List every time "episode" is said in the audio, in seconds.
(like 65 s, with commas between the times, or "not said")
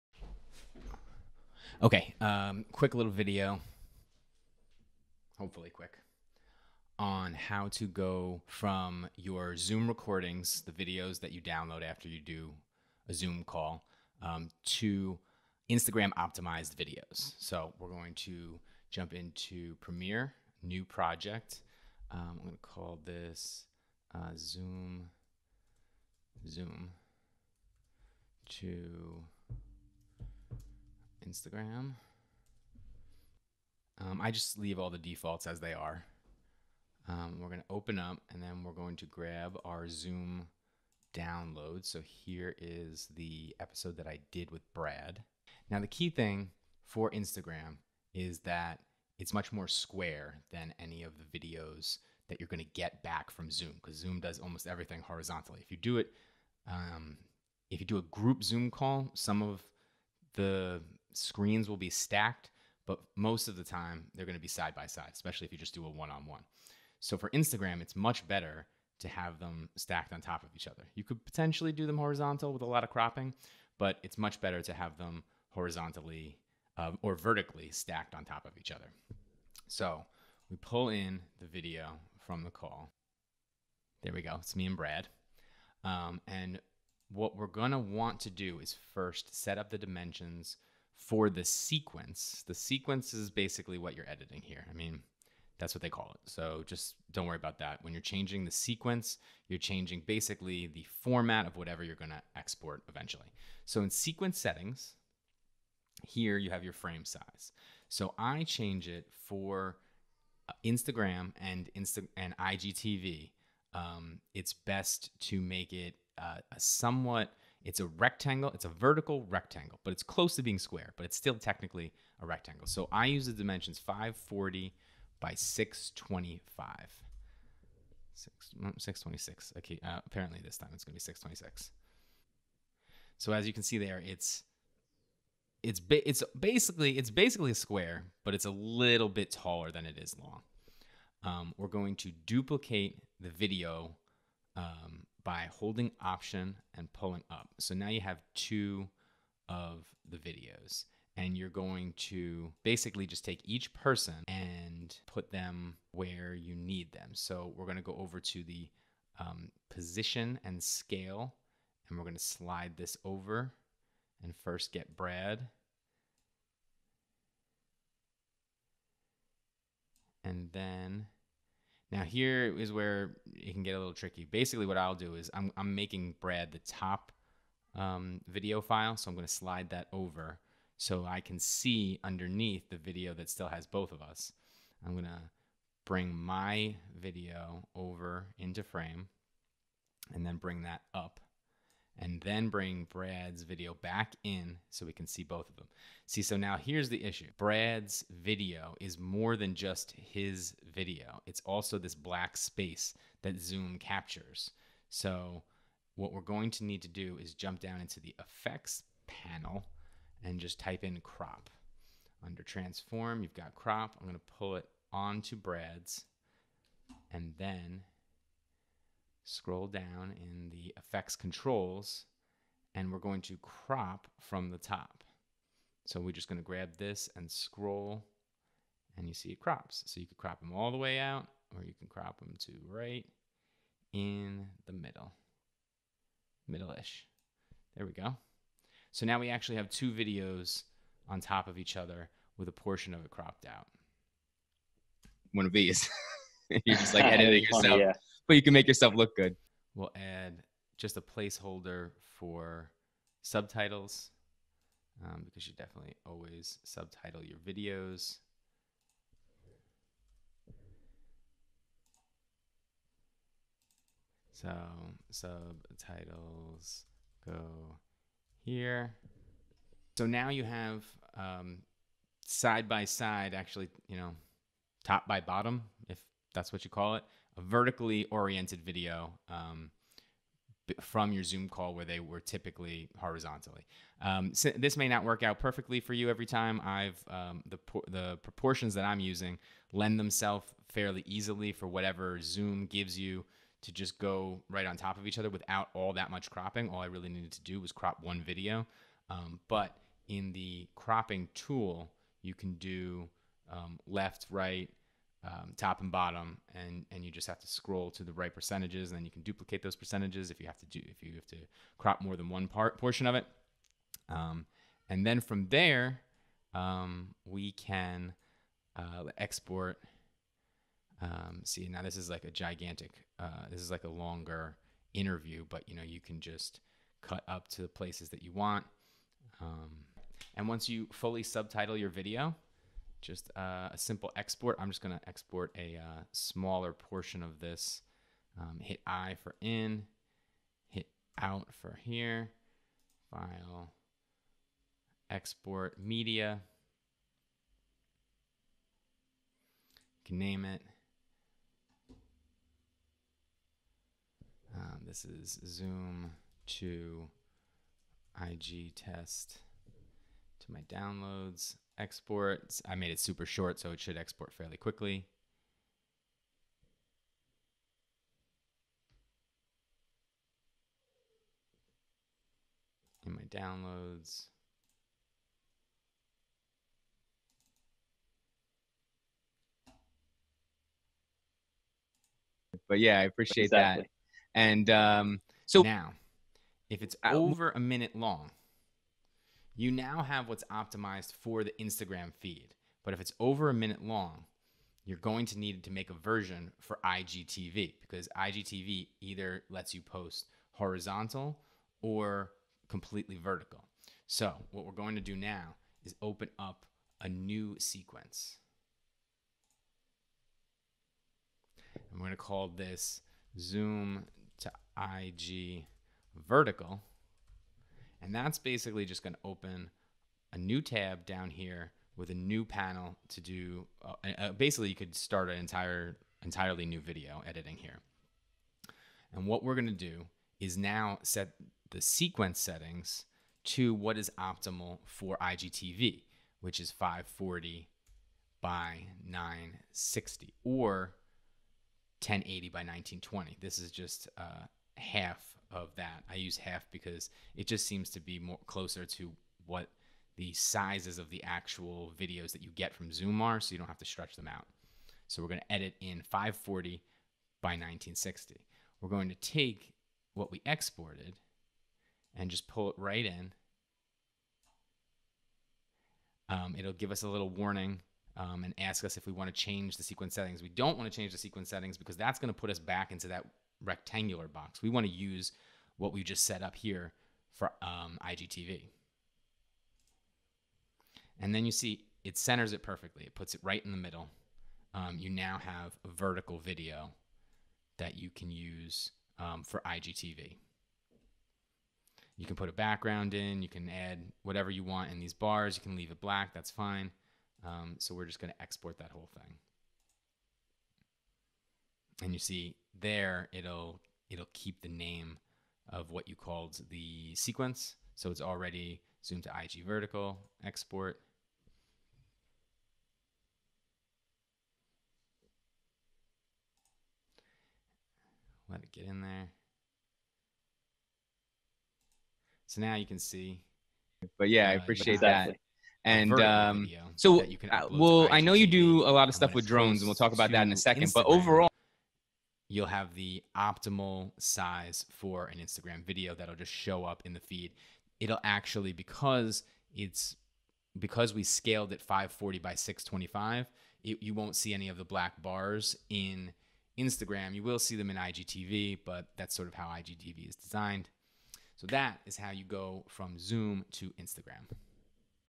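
43 s.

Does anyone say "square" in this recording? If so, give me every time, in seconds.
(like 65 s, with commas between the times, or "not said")
49 s, 120 s, 137 s.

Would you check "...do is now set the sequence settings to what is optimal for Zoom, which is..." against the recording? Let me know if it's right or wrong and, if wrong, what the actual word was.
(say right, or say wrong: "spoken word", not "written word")
wrong: "IGTV", not "Zoom".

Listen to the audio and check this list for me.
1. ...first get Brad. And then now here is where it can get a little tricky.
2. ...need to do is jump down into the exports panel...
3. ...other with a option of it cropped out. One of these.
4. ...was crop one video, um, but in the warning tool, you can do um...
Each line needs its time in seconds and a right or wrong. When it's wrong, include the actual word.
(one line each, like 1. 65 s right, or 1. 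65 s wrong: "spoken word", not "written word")
1. 164 s right
2. 206 s wrong: "effects", not "exports"
3. 241 s wrong: "portion", not "option"
4. 297 s wrong: "cropping", not "warning".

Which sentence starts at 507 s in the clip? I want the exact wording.
So it's already zoomed to IG vertical, export.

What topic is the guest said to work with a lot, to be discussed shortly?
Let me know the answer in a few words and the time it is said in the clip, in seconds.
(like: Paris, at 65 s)
drones, at 529 s.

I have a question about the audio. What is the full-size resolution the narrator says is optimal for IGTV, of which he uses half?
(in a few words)
1080 by 1920.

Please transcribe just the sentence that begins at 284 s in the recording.
Um, so this may not work out perfectly for you every time.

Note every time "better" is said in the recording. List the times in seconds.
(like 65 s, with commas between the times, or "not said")
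68 s, 74 s.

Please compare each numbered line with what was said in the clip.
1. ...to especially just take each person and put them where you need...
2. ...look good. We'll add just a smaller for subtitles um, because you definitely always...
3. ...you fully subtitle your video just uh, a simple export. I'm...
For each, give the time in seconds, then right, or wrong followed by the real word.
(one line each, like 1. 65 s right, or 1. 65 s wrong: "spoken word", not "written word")
1. 151 s wrong: "basically", not "especially"
2. 248 s wrong: "placeholder", not "smaller"
3. 330 s right.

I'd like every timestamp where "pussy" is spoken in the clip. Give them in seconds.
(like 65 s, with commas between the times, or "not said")
not said.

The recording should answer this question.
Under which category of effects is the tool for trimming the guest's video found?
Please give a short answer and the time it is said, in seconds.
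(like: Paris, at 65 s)
transform, at 212 s.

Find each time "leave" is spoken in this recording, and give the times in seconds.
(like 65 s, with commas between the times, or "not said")
34 s, 495 s.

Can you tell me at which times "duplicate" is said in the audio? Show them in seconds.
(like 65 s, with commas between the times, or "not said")
142 s, 309 s.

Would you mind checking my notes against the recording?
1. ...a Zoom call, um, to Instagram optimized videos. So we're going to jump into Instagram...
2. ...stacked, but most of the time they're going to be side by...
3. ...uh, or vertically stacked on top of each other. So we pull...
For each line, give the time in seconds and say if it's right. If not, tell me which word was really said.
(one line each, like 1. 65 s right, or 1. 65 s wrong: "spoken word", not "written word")
1. 13 s wrong: "Premiere", not "Instagram"
2. 61 s right
3. 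76 s right.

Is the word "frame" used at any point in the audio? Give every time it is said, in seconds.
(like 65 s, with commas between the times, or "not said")
106 s, 188 s.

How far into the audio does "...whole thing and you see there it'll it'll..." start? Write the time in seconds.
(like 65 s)
498 s.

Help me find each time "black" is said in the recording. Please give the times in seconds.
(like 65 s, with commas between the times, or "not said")
201 s, 496 s, 544 s.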